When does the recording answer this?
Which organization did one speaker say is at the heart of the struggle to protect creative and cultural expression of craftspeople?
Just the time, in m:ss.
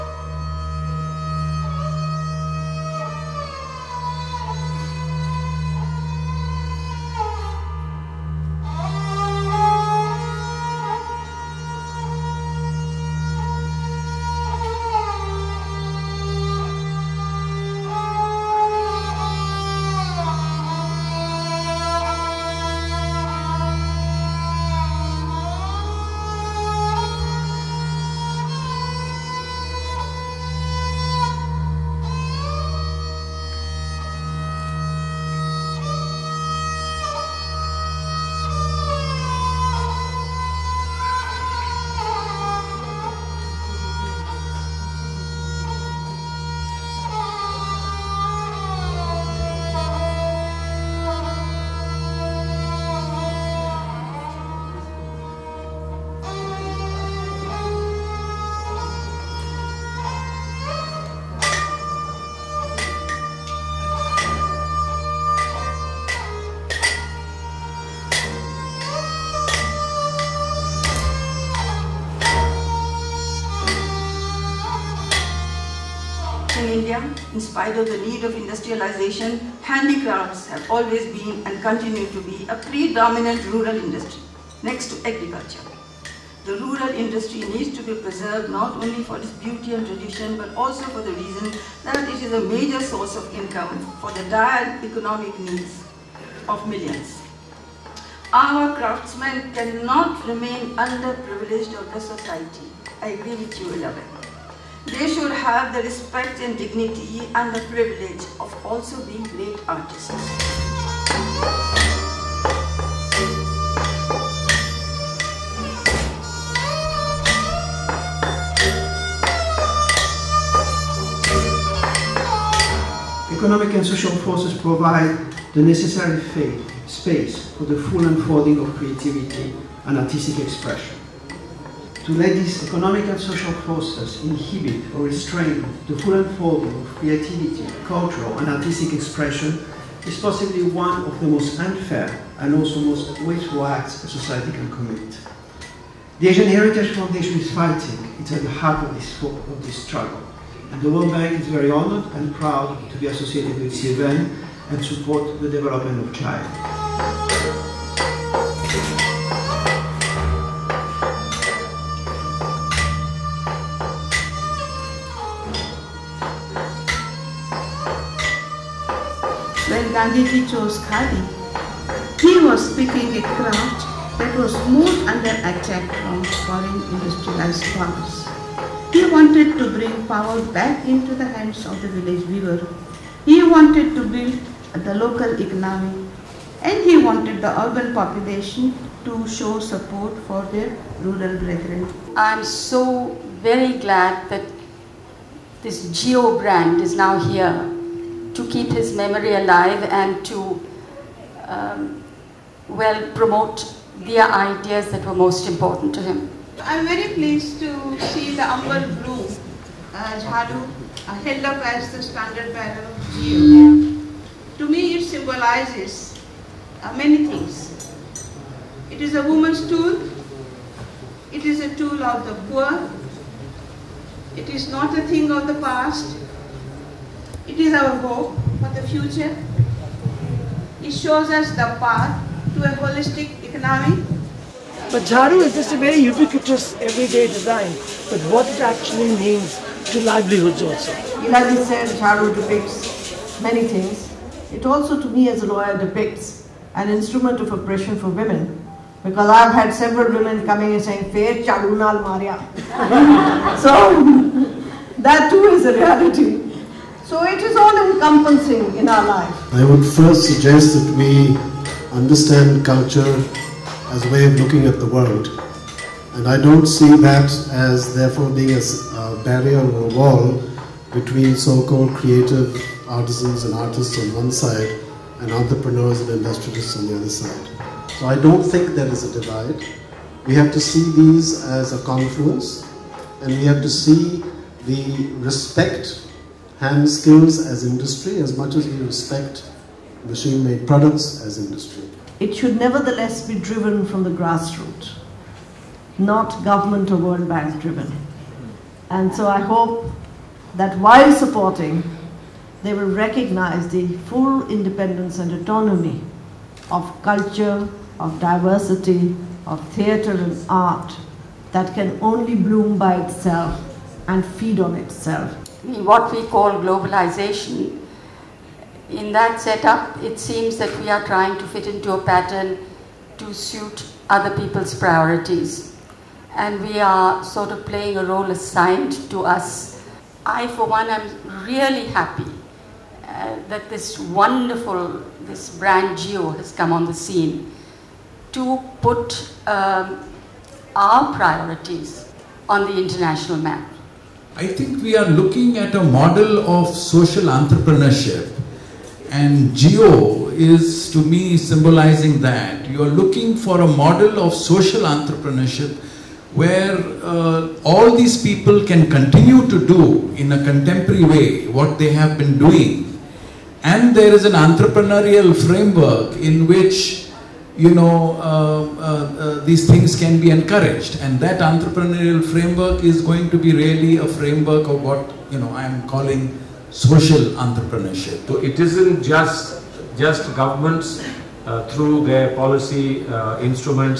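2:26.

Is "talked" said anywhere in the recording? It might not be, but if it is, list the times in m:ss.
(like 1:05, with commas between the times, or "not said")
not said.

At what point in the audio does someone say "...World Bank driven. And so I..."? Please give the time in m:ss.
4:56.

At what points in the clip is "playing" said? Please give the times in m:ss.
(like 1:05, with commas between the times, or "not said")
5:27.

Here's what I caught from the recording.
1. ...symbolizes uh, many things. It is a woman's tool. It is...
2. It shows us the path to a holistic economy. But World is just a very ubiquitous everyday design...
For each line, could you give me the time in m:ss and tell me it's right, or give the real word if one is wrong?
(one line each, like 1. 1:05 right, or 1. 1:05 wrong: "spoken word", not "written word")
1. 3:35 right
2. 3:50 wrong: "Jharu", not "World".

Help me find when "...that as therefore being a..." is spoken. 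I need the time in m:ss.
4:26.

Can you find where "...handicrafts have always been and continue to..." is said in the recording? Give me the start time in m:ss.
1:19.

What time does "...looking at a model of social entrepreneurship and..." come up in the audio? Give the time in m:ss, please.
5:45.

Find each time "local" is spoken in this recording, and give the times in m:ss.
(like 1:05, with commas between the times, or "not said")
3:04.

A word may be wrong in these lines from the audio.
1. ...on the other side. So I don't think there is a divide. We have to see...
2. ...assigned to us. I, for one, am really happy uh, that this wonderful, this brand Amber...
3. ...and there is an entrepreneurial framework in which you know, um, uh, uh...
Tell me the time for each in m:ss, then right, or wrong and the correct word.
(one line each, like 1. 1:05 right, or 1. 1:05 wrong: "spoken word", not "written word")
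1. 4:36 right
2. 5:28 wrong: "JIYO", not "Amber"
3. 6:03 right.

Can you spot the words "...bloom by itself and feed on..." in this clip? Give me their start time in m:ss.
5:12.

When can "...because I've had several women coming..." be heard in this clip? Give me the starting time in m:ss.
4:09.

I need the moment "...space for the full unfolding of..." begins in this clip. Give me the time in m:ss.
2:06.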